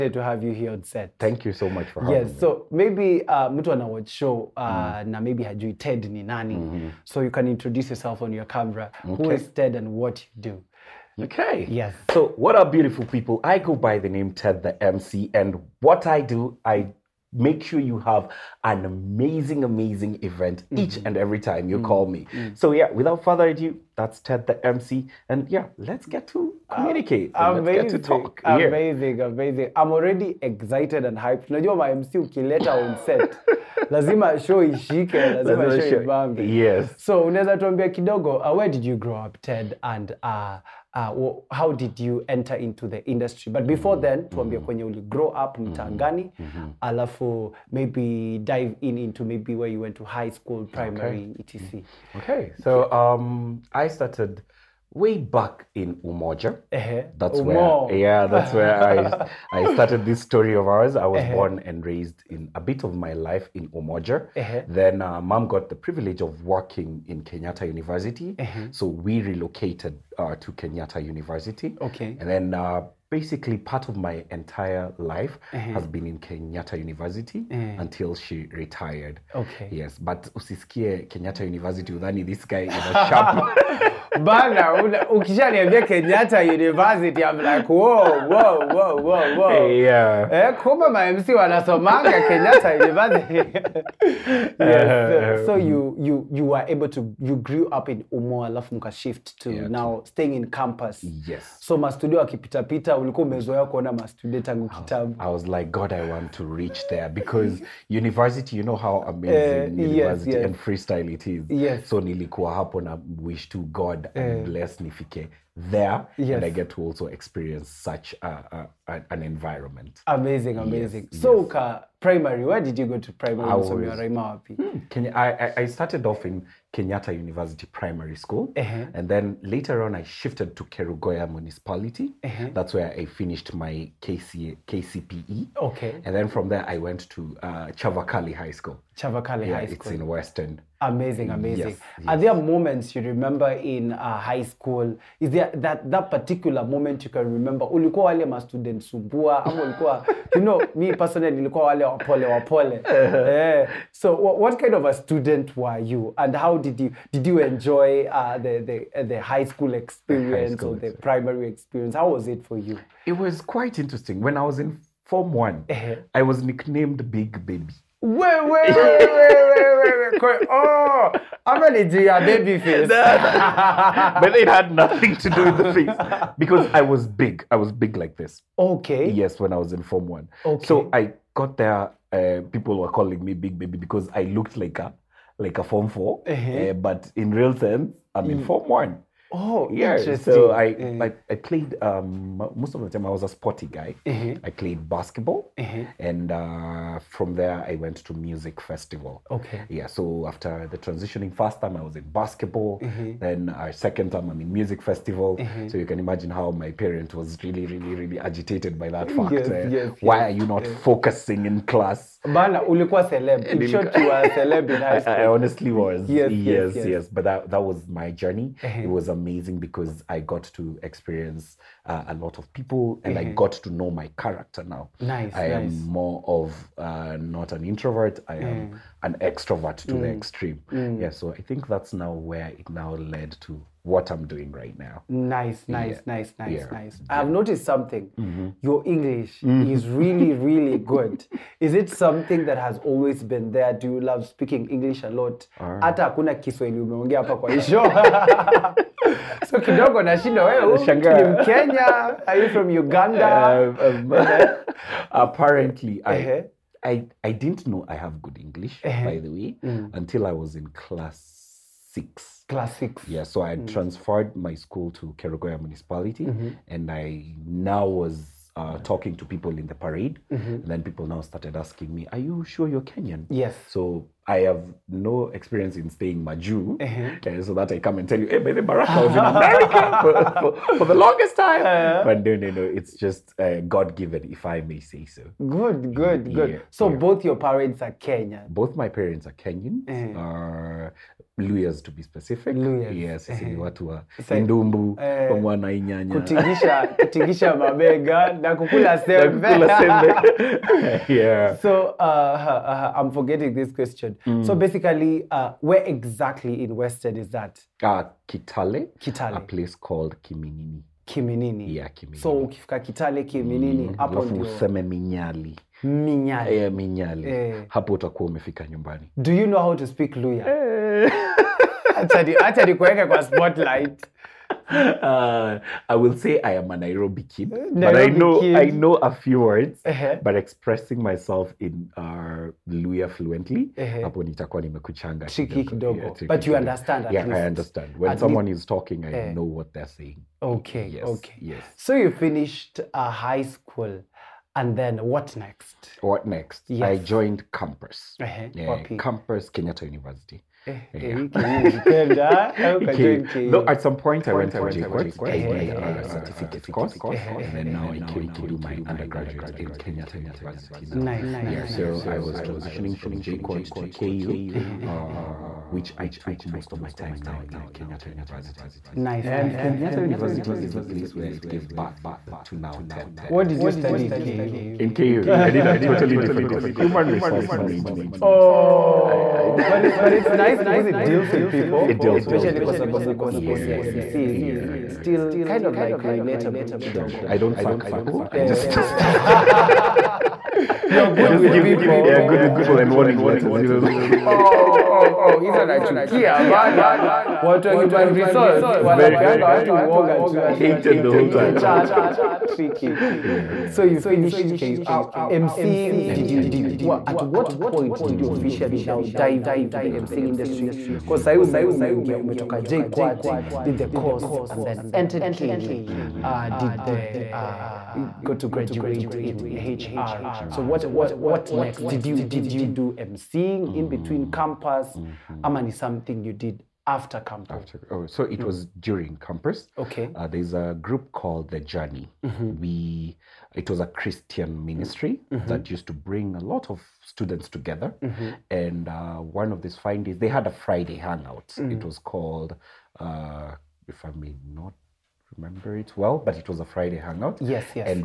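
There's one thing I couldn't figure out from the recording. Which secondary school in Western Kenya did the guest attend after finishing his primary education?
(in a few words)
Chavakali High School.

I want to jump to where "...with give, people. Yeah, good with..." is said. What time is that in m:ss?
6:31.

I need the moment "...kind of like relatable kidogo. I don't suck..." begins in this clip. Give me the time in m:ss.
6:25.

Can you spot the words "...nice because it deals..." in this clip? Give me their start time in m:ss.
6:20.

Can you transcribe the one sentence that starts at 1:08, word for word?
so we relocated uh, to Kenyatta University.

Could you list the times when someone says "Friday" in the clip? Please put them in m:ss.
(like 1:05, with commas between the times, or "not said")
7:20, 7:26.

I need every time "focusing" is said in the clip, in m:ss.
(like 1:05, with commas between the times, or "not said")
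3:30.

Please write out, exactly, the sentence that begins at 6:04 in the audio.
uh, which I took most of my time now in Kenyatta University.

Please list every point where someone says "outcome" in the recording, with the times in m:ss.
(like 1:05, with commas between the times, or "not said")
not said.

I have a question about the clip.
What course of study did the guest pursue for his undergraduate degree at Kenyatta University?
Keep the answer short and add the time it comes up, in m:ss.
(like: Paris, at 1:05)
Human resource management, at 6:16.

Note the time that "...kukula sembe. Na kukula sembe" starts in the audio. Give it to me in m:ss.
4:58.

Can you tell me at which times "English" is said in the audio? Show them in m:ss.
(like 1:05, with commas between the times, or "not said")
3:58, 4:04, 4:18.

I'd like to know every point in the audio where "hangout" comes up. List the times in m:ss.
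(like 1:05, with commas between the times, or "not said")
7:20, 7:26.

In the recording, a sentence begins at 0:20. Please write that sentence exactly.
each and every time you mm-hmm.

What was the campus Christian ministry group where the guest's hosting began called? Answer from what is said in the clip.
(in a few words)
The Journey.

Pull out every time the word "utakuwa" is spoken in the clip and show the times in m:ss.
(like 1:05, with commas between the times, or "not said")
5:17.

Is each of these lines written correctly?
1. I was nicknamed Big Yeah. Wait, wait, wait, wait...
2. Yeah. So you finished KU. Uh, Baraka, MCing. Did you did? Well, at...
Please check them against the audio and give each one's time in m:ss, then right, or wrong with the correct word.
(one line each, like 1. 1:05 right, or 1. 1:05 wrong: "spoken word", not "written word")
1. 2:46 wrong: "Baby", not "Yeah"
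2. 6:43 wrong: "MCing", not "Baraka".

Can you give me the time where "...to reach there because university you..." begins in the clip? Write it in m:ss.
1:46.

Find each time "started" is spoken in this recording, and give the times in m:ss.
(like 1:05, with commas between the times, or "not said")
0:53, 0:59, 2:05, 4:31.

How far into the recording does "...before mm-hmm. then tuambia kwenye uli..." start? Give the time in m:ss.
0:43.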